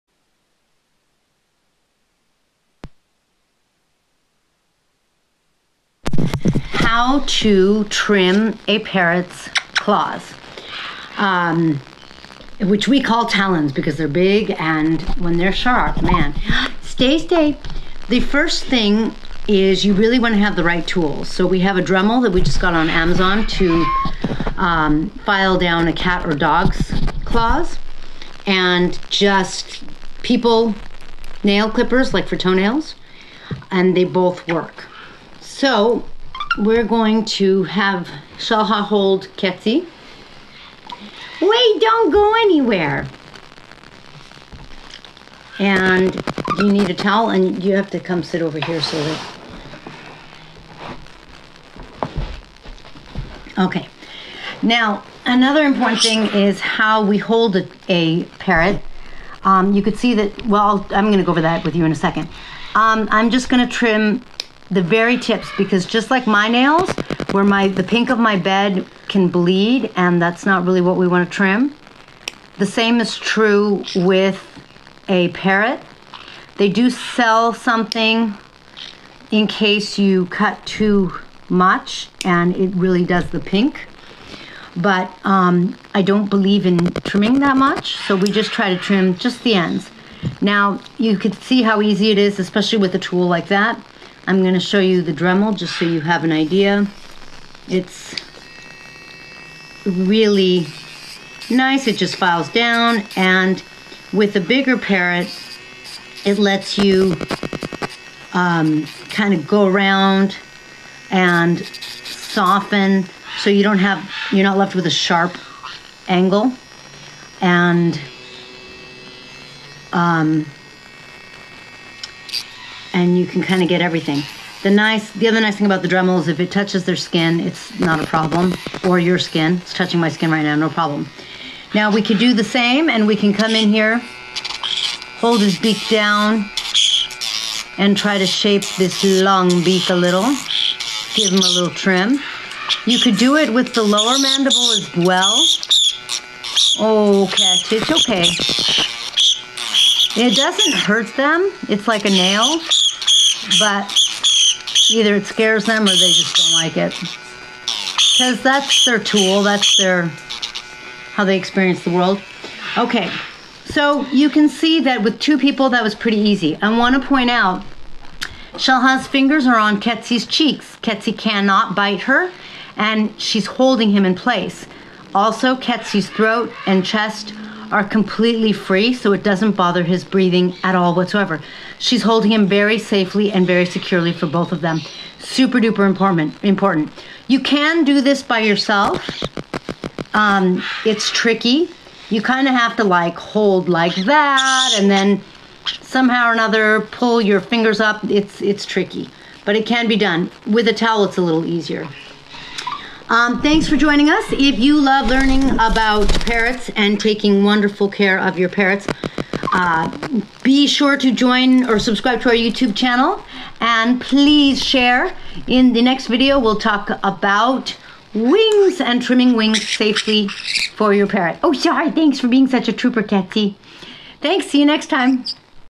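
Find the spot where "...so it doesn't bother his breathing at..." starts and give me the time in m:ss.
2:58.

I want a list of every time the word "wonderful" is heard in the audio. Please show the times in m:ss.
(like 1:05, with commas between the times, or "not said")
3:27.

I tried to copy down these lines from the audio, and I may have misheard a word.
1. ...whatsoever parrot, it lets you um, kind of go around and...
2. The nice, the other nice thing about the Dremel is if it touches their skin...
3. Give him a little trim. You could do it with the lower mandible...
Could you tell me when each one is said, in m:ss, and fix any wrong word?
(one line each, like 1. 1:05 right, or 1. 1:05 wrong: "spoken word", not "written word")
1. 1:44 wrong: "bigger", not "whatsoever"
2. 2:04 right
3. 2:21 right.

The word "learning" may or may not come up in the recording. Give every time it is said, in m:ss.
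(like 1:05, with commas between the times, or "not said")
3:25.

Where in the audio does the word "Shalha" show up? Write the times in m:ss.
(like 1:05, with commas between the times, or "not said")
0:38, 2:48.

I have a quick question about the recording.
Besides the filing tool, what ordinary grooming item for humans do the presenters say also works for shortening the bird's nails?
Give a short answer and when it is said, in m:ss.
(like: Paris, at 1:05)
Nail clippers, at 0:31.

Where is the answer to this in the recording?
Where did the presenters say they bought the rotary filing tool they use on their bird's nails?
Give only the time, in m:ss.
0:22.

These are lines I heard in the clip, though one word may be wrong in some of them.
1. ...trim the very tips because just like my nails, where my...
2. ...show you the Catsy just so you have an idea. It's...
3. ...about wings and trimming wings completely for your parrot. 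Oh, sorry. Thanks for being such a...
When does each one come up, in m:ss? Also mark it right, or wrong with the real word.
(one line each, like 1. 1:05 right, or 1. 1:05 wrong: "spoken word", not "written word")
1. 1:03 right
2. 1:34 wrong: "Dremel", not "Catsy"
3. 3:37 wrong: "safely", not "completely".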